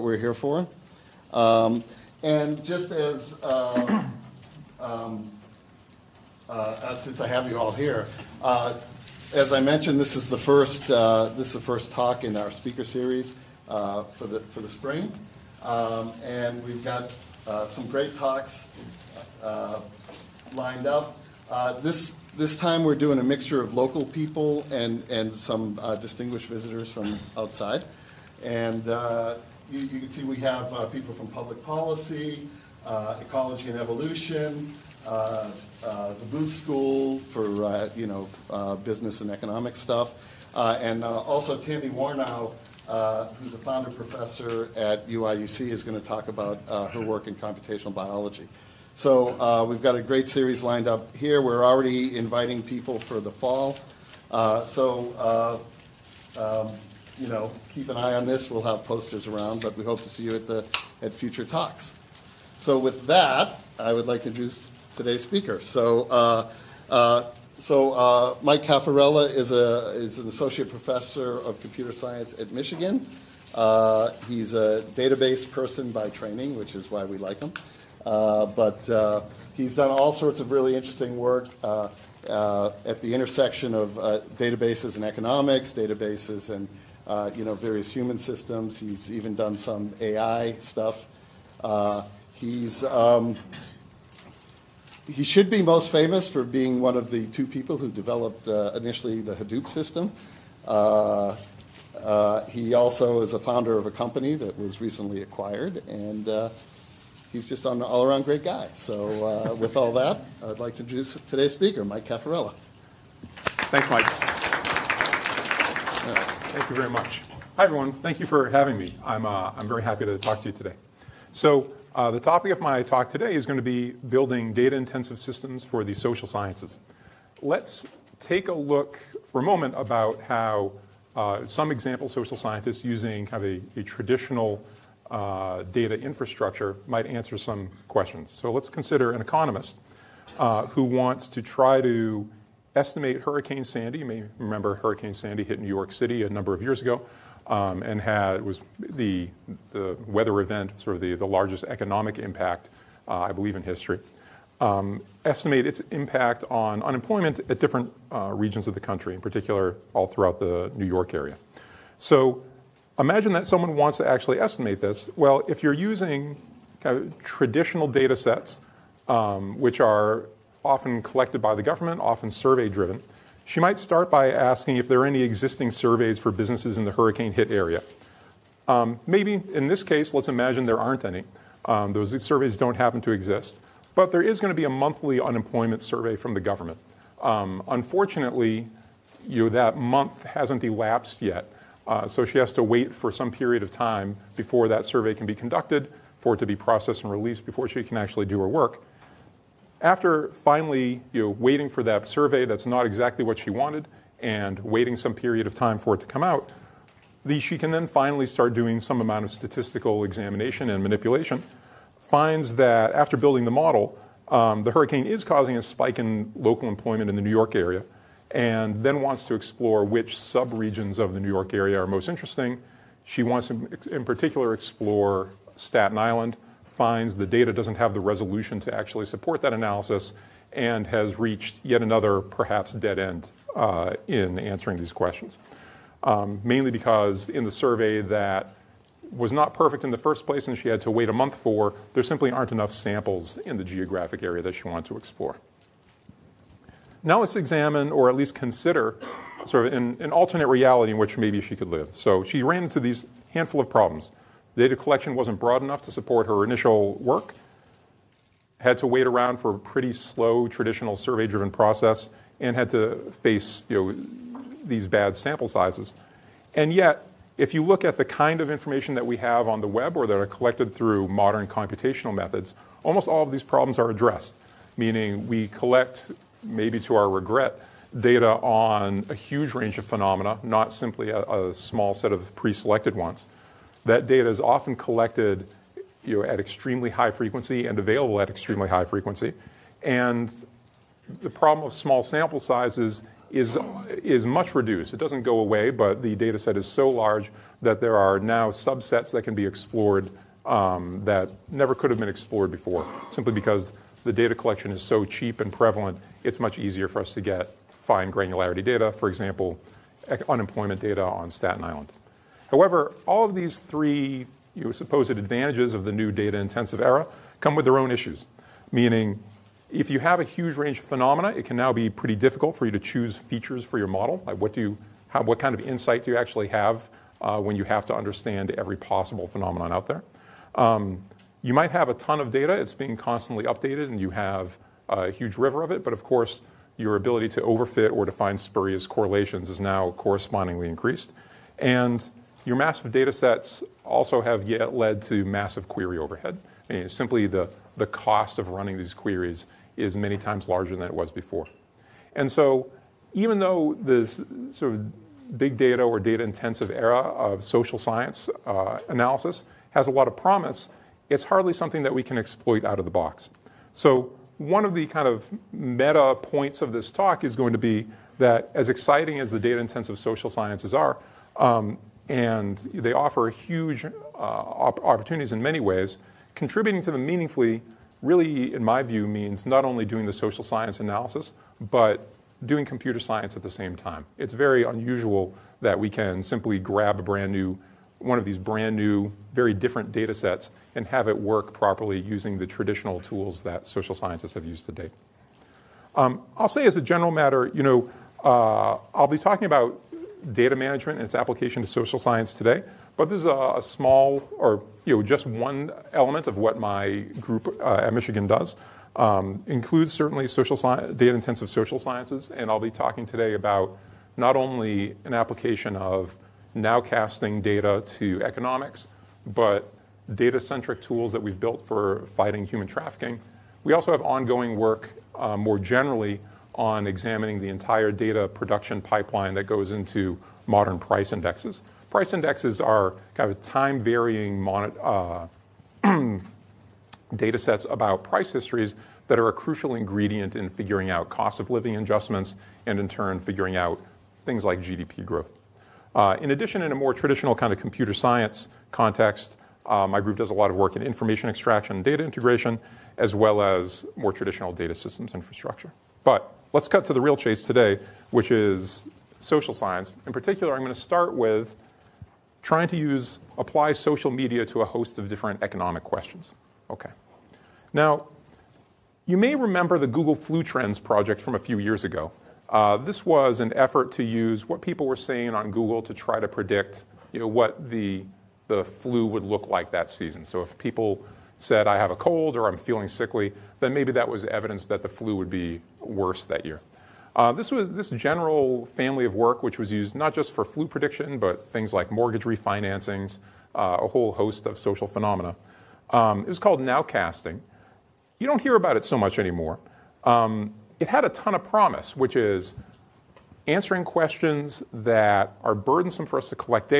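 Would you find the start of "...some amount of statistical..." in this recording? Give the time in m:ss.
3:28.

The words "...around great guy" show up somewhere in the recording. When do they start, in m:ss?
1:48.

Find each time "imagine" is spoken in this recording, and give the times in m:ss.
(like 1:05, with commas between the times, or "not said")
2:42, 3:00.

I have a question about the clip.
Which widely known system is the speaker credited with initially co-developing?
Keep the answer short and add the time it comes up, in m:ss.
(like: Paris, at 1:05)
Hadoop, at 1:39.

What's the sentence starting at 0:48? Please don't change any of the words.
So uh, we've got a great series lined up here.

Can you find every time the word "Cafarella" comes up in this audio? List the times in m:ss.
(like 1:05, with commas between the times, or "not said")
1:08, 1:52.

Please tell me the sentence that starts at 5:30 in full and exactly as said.
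Um, you might have a ton of data; it's being constantly updated, and you have a huge river of it.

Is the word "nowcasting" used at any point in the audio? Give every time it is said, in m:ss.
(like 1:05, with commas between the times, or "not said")
6:56, 8:16.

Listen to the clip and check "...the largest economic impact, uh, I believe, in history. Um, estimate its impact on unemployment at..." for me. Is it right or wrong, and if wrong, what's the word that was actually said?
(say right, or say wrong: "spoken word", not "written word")
right.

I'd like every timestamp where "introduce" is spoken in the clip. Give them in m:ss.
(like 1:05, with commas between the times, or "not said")
1:04, 1:50.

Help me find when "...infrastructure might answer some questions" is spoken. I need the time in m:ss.
2:15.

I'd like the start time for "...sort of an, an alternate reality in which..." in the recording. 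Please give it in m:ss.
4:09.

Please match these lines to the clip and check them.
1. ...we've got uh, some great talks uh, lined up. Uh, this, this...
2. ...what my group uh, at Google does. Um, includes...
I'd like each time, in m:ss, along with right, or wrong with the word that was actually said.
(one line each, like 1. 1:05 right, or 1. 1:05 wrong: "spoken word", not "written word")
1. 0:16 right
2. 6:46 wrong: "Michigan", not "Google".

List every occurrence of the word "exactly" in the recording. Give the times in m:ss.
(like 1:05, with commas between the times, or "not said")
3:22.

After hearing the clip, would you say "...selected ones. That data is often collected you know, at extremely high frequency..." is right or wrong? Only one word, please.
right.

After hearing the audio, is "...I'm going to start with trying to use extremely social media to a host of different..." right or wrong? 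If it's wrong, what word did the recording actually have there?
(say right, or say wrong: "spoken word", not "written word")
wrong: "apply", not "extremely".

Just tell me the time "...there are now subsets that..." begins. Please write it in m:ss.
4:57.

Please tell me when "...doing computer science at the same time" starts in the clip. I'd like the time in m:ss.
6:22.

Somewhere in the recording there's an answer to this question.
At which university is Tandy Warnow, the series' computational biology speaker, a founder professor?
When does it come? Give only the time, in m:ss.
0:45.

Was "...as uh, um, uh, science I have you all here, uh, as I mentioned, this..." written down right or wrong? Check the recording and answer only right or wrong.
wrong.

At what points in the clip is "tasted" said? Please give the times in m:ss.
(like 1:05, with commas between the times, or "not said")
not said.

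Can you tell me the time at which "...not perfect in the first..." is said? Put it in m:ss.
3:59.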